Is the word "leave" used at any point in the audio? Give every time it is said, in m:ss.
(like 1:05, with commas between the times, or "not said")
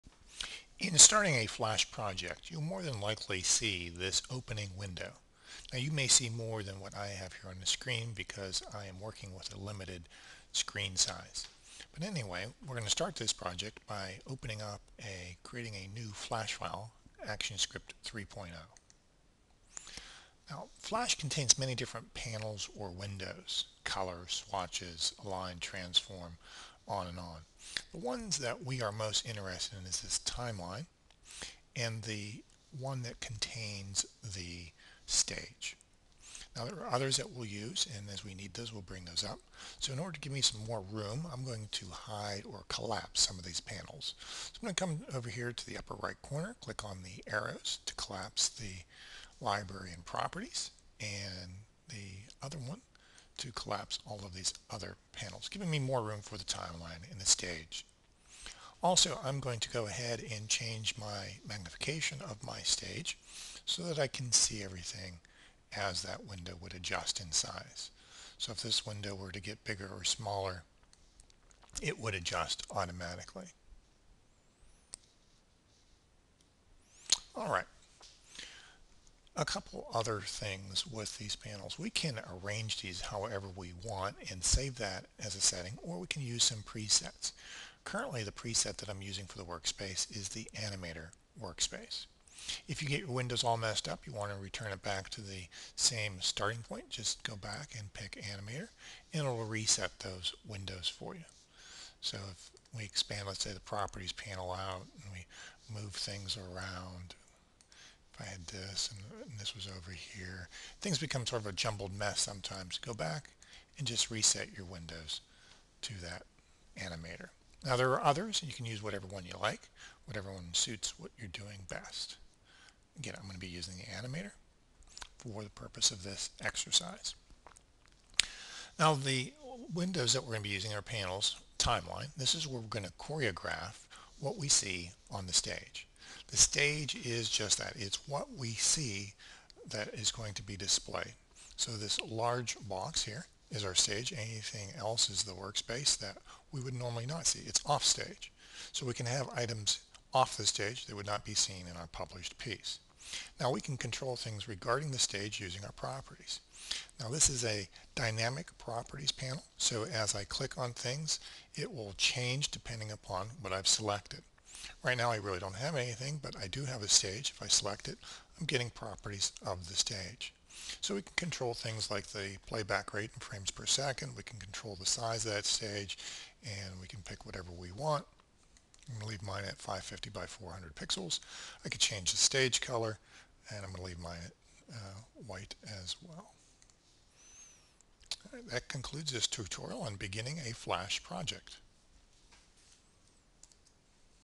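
2:59, 3:03.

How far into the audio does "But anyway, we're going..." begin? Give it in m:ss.
0:11.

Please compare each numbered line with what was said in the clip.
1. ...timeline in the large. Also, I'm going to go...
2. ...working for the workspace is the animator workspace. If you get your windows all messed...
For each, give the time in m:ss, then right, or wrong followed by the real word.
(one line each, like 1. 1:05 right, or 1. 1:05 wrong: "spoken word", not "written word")
1. 0:56 wrong: "stage", not "large"
2. 1:29 wrong: "using", not "working".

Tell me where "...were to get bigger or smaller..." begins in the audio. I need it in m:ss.
1:09.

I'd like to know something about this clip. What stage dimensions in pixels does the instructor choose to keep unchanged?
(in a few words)
550 by 400.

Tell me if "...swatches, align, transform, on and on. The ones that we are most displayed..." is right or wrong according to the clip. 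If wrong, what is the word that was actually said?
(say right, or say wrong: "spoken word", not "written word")
wrong: "interested", not "displayed".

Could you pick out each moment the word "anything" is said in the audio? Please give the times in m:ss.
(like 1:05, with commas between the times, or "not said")
2:24, 2:45.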